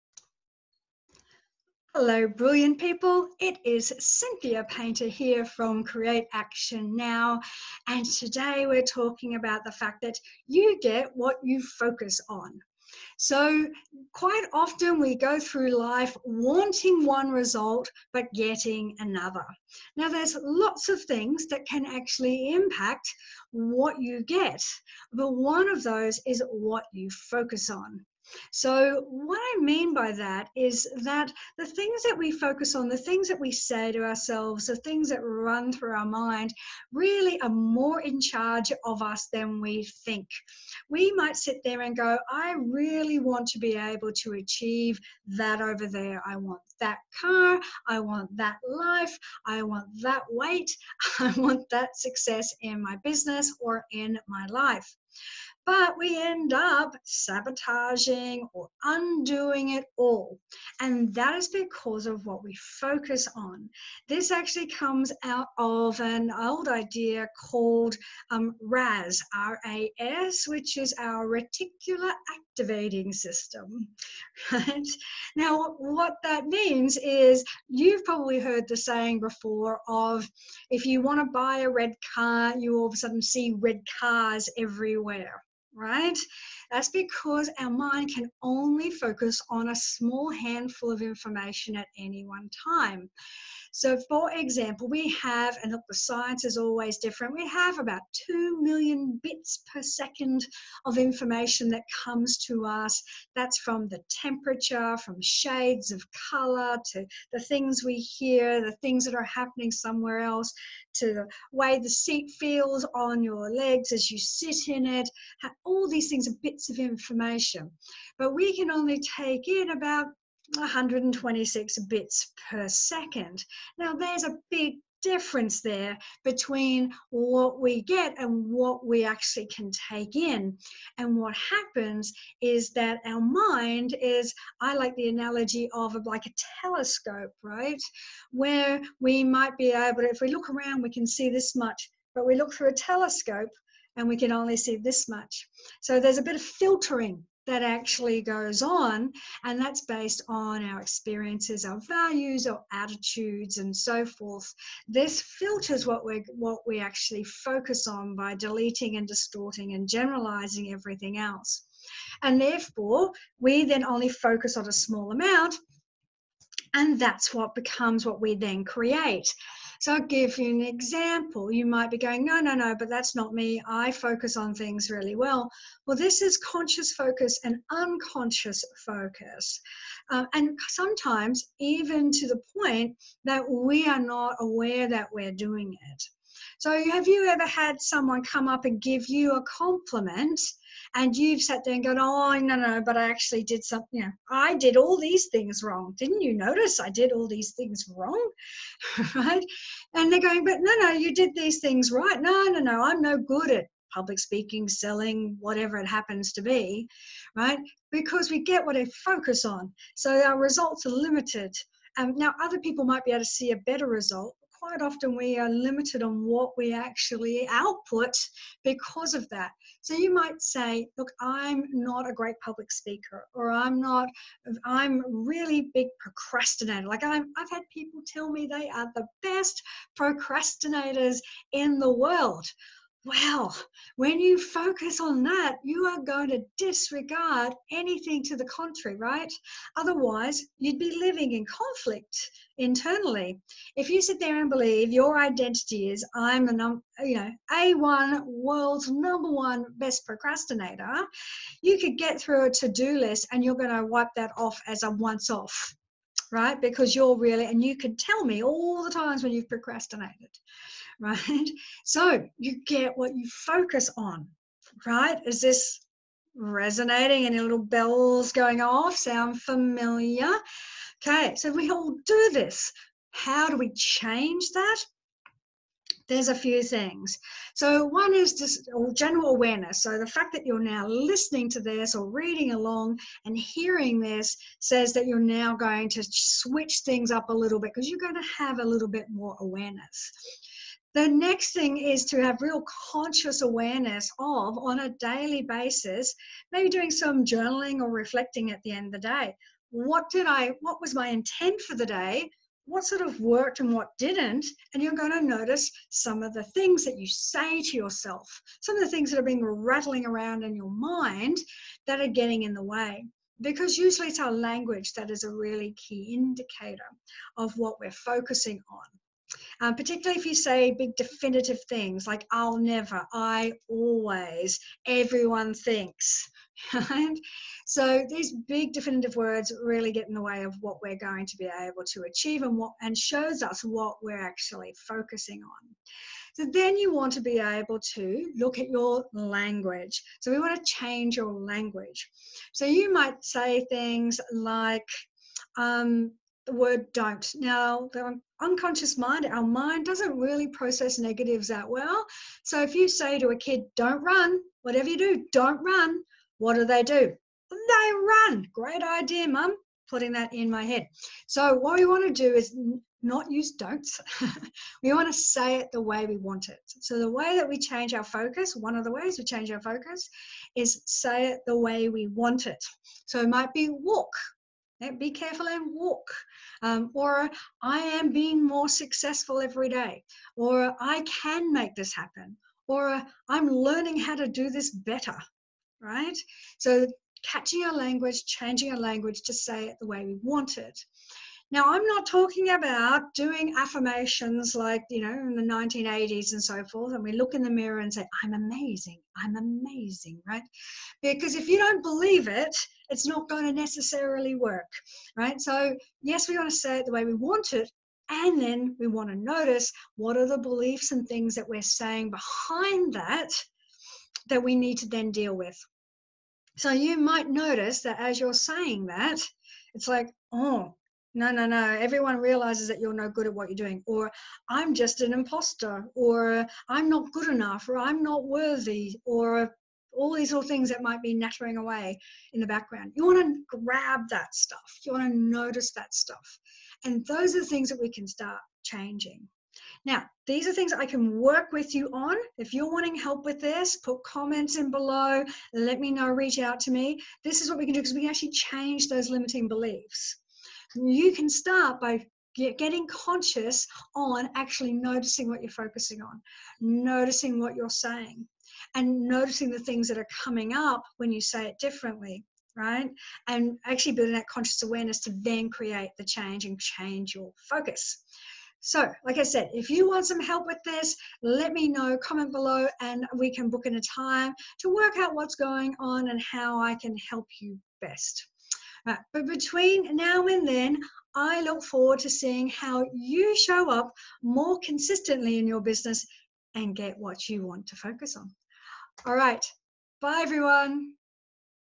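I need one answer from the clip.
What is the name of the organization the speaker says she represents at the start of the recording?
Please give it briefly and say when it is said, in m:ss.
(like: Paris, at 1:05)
Create Action Now, at 0:05.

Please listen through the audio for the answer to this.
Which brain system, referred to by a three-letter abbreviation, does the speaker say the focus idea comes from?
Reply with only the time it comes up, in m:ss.
1:11.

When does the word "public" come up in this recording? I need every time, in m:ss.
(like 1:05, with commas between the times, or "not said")
3:23, 3:42.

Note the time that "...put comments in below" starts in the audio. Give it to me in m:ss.
7:23.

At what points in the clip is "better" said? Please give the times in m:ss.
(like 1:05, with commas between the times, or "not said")
3:33, 6:24.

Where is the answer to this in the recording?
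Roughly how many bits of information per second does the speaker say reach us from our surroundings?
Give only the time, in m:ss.
1:38.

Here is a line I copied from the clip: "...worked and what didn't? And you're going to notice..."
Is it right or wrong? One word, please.
right.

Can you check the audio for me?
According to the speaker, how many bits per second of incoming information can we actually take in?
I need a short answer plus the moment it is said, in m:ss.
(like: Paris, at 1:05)
126, at 2:00.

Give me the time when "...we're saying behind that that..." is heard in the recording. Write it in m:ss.
6:51.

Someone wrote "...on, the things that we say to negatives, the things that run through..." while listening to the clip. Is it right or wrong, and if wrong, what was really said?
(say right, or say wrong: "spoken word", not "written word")
wrong: "ourselves", not "negatives".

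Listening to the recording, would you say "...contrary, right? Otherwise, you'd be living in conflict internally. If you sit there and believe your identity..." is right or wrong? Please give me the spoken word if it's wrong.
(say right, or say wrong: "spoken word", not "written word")
right.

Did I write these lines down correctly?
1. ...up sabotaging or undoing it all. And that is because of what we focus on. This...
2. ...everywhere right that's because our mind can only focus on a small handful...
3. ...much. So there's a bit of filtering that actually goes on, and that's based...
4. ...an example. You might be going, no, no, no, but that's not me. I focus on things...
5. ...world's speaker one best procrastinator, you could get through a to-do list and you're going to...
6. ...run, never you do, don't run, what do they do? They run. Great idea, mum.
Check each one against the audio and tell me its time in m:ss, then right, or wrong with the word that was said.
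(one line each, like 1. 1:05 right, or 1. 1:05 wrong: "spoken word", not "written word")
1. 0:56 right
2. 1:24 right
3. 2:25 right
4. 2:50 right
5. 4:08 wrong: "number", not "speaker"
6. 5:54 wrong: "whatever", not "never".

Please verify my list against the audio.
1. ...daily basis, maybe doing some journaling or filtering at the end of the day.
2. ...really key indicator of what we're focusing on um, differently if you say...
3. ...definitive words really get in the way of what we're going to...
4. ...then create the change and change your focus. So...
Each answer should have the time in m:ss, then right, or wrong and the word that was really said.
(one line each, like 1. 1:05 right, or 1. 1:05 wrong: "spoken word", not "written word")
1. 4:54 wrong: "reflecting", not "filtering"
2. 5:15 wrong: "particularly", not "differently"
3. 5:28 right
4. 7:45 right.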